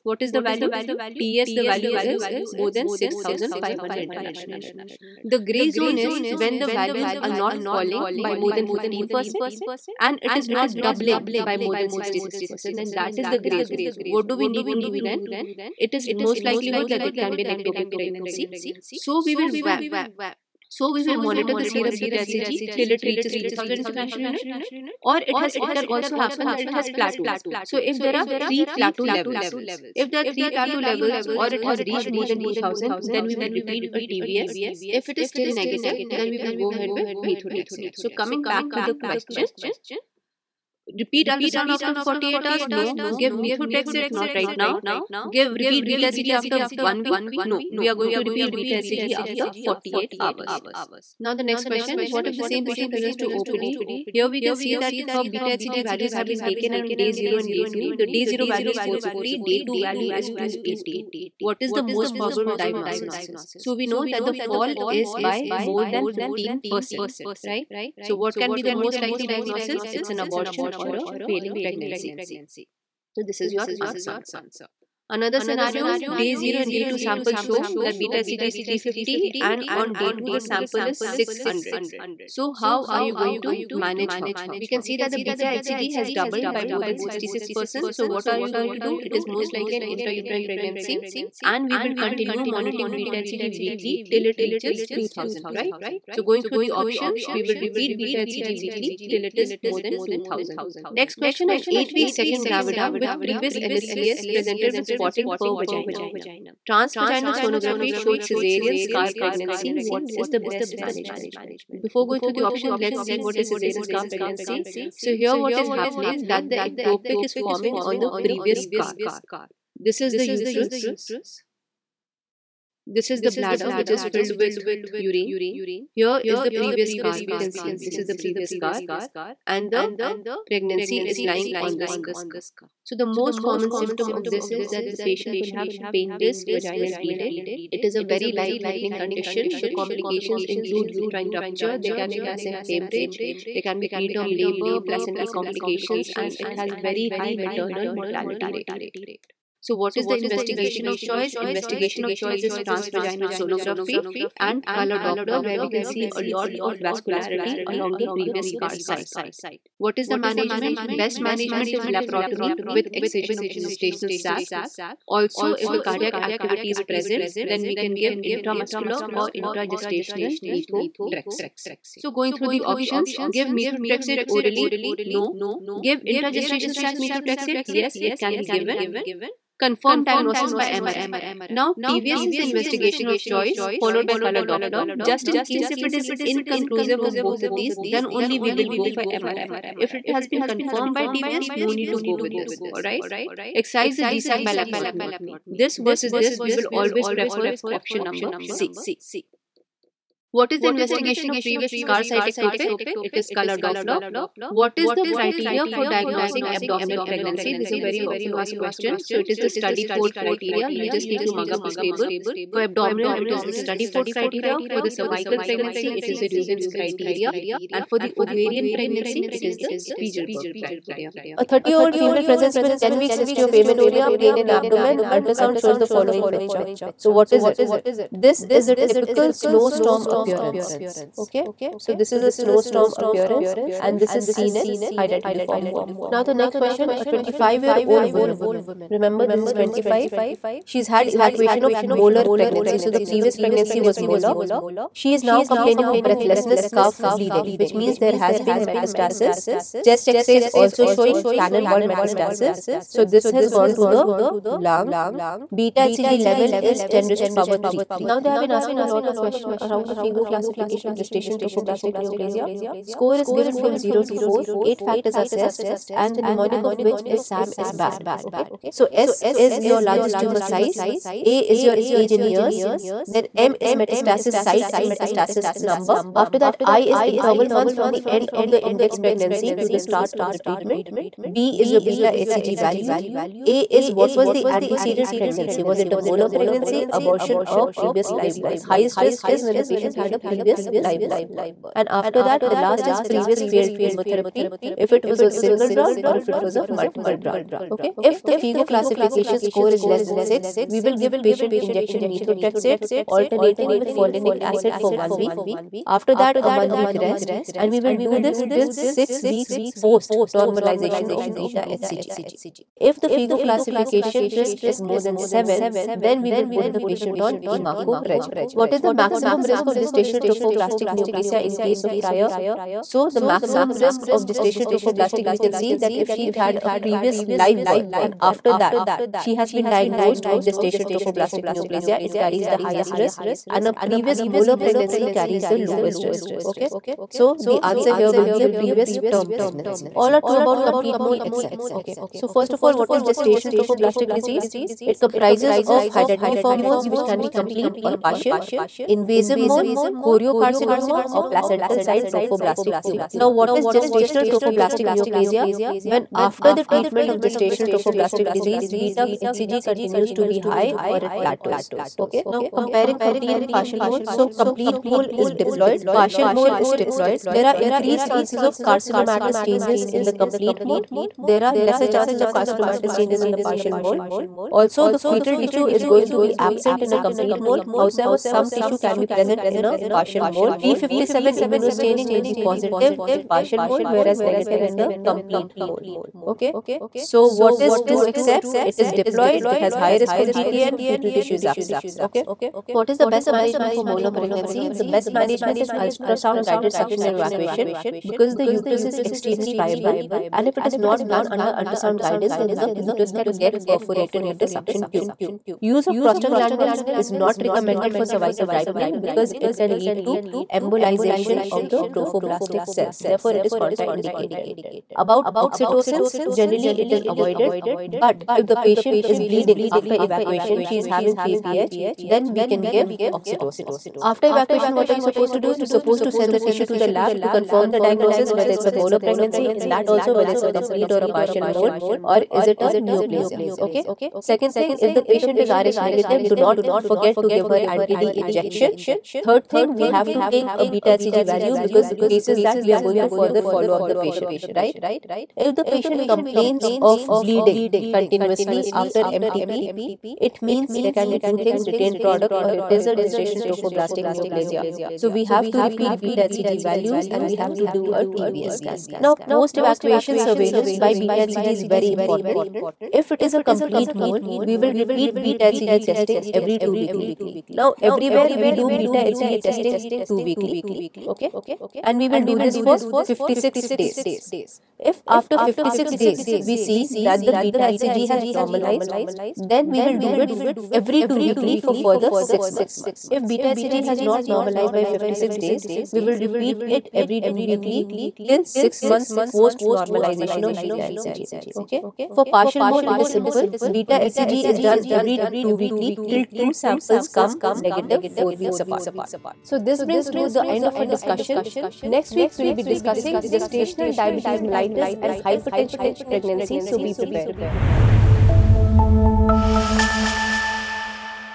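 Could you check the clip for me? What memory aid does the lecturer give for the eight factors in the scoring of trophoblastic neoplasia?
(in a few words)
SAM is bad.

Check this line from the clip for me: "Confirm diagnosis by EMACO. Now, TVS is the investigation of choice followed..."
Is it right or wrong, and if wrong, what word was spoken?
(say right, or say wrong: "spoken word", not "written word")
wrong: "MRI", not "EMACO".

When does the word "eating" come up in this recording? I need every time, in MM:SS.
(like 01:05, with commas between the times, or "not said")
not said.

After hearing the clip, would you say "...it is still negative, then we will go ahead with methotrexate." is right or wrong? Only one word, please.
right.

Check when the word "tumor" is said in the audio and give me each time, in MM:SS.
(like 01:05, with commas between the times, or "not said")
04:30, 05:52.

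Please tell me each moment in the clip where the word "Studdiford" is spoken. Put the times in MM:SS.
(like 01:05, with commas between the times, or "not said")
03:29, 03:33.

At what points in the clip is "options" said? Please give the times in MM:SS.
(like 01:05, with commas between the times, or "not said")
01:36, 01:52, 02:52, 03:17.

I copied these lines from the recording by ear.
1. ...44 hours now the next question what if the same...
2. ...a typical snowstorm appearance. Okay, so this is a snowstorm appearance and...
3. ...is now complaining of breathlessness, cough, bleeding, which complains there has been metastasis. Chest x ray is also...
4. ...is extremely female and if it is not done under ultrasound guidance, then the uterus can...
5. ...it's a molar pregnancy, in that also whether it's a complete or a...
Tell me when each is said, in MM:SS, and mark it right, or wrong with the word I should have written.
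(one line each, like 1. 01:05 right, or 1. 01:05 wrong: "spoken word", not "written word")
1. 00:49 wrong: "48", not "44"
2. 03:48 right
3. 04:05 wrong: "means", not "complains"
4. 06:38 wrong: "friable", not "female"
5. 07:08 right.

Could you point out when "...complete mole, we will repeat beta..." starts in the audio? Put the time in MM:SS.
07:43.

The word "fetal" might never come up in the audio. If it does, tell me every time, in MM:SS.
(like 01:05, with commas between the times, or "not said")
06:14, 06:30.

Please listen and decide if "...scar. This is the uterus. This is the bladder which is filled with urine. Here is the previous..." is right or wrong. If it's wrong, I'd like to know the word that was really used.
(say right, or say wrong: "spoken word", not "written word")
right.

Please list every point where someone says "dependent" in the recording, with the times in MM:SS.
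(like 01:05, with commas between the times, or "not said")
not said.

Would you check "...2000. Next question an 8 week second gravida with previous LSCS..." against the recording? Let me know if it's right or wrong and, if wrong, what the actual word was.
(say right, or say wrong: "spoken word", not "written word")
right.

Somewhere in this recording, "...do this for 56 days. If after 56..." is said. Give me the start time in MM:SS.
07:52.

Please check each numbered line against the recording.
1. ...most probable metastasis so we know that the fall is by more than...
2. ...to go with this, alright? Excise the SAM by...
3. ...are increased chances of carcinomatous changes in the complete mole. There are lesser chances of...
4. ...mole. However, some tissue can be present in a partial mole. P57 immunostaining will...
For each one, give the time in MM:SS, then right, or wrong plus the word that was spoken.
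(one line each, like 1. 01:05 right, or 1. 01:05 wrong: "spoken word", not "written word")
1. 01:01 wrong: "diagnosis", not "metastasis"
2. 03:11 wrong: "GSAC", not "SAM"
3. 06:07 right
4. 06:17 right.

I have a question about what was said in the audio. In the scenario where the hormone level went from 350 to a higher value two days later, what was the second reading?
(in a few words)
600.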